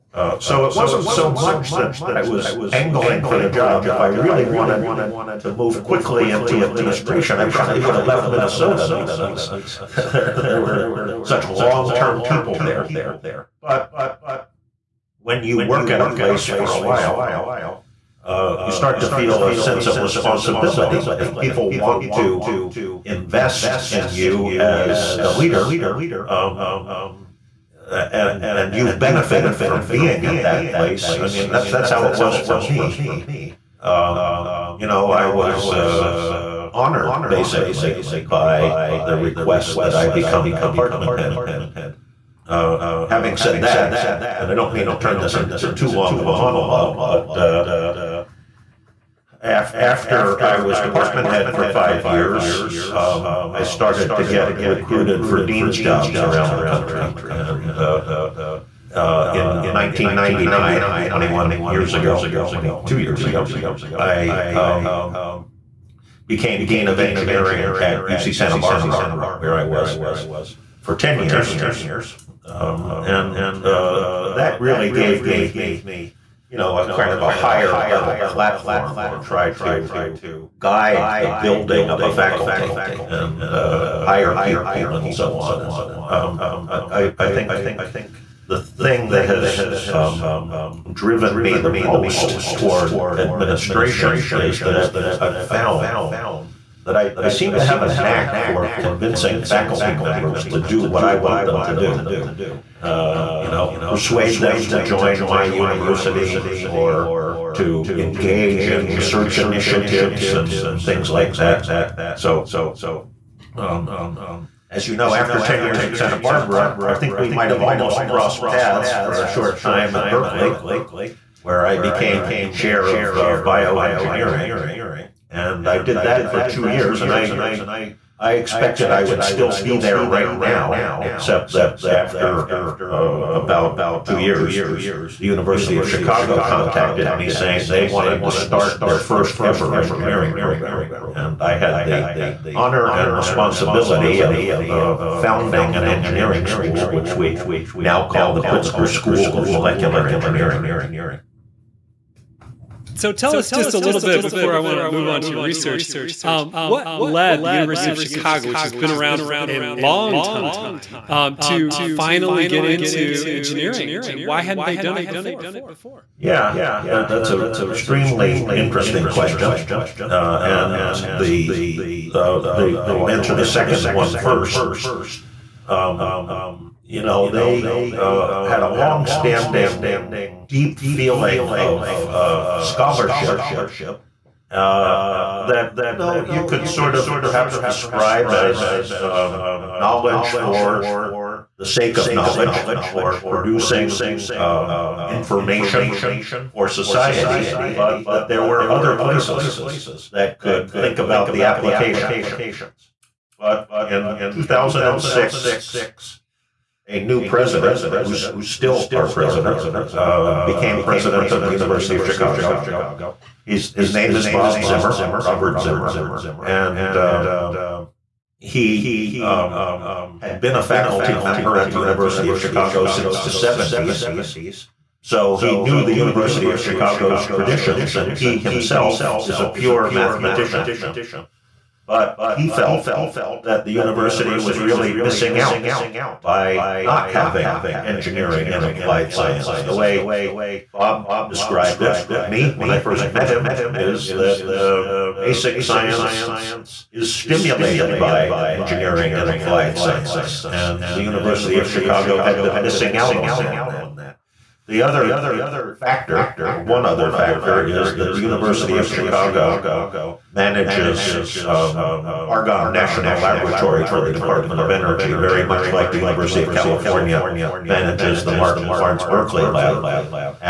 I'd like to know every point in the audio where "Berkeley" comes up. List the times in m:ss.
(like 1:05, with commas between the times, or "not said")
2:00, 4:29.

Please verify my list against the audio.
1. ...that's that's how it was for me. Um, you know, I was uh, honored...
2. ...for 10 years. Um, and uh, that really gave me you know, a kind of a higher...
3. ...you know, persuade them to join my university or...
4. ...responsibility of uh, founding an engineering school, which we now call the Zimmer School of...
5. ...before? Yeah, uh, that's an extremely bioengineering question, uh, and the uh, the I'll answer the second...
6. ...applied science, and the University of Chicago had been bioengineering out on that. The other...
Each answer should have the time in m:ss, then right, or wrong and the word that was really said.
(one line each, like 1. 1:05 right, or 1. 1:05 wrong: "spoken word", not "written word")
1. 0:31 right
2. 1:10 right
3. 1:43 right
4. 2:23 wrong: "Pritzker", not "Zimmer"
5. 2:45 wrong: "interesting", not "bioengineering"
6. 4:09 wrong: "missing", not "bioengineering".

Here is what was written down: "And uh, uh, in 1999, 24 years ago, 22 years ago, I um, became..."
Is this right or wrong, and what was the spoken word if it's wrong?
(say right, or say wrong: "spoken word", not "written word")
wrong: "21", not "24".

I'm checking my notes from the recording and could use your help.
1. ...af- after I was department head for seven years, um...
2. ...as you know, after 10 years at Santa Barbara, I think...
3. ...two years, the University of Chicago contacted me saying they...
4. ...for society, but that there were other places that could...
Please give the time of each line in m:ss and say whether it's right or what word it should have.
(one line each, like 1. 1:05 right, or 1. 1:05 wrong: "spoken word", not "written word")
1. 0:49 wrong: "five", not "seven"
2. 1:54 right
3. 2:14 right
4. 3:16 right.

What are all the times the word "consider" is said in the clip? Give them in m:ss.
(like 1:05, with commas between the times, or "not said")
not said.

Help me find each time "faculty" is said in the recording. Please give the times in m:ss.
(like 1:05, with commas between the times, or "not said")
1:22, 1:39, 3:40.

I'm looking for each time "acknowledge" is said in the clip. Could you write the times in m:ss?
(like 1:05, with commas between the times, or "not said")
not said.